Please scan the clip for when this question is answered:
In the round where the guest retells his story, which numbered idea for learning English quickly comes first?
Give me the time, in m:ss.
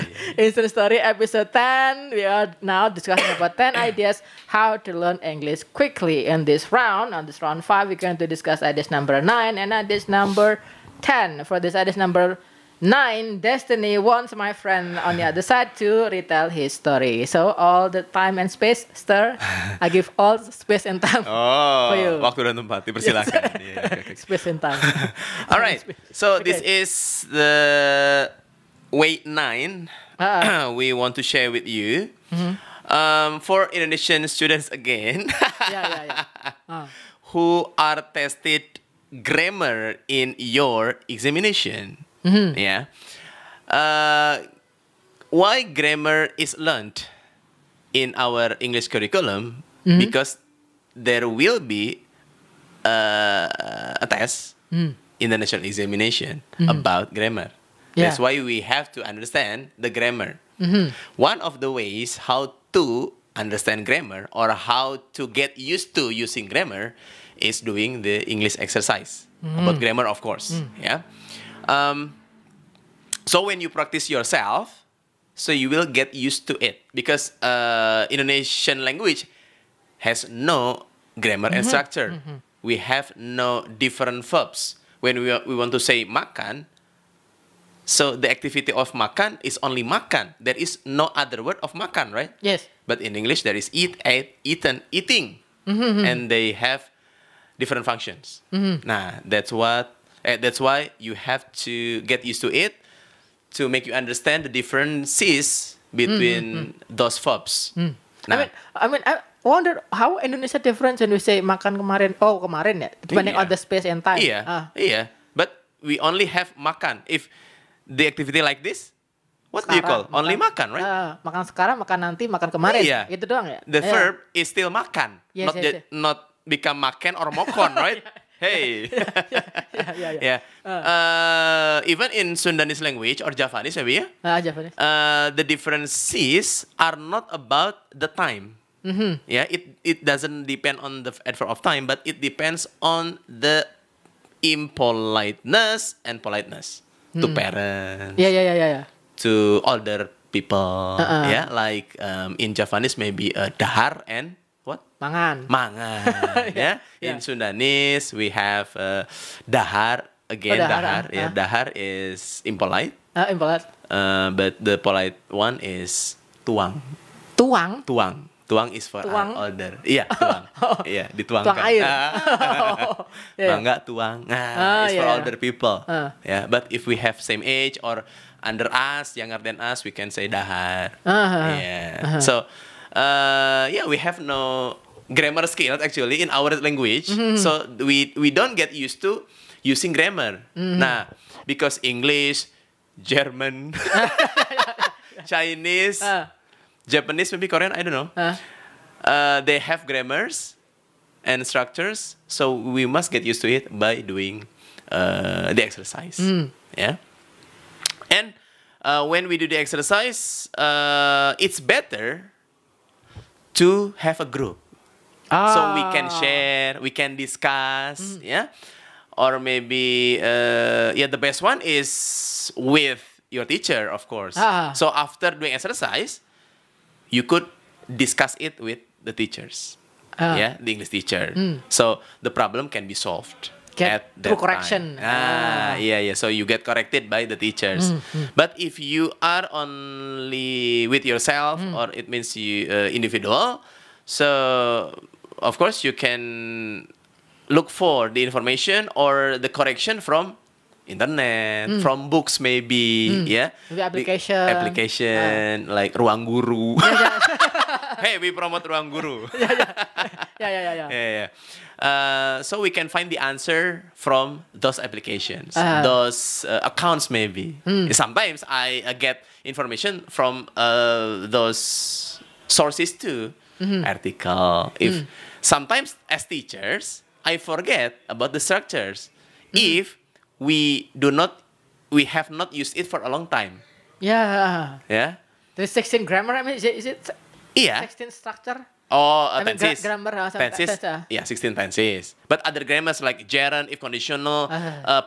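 0:11.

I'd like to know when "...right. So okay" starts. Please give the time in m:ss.
0:25.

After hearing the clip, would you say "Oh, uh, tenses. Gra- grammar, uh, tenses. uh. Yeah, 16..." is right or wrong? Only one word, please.
right.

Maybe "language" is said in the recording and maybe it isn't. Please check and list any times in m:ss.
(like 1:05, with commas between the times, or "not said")
1:18, 2:12, 3:06.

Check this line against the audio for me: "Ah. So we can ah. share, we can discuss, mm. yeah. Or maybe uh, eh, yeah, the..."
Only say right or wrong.
right.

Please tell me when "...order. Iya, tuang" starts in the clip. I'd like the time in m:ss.
2:49.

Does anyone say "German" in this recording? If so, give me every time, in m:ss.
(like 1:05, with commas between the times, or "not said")
3:13.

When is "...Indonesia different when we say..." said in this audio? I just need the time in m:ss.
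1:50.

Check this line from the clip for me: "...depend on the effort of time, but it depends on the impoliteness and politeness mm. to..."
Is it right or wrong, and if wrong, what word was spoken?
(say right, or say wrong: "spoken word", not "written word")
right.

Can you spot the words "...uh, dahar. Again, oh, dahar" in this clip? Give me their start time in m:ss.
2:38.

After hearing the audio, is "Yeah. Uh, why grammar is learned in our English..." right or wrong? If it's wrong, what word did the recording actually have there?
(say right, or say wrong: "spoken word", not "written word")
right.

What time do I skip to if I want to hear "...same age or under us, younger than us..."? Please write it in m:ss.
2:57.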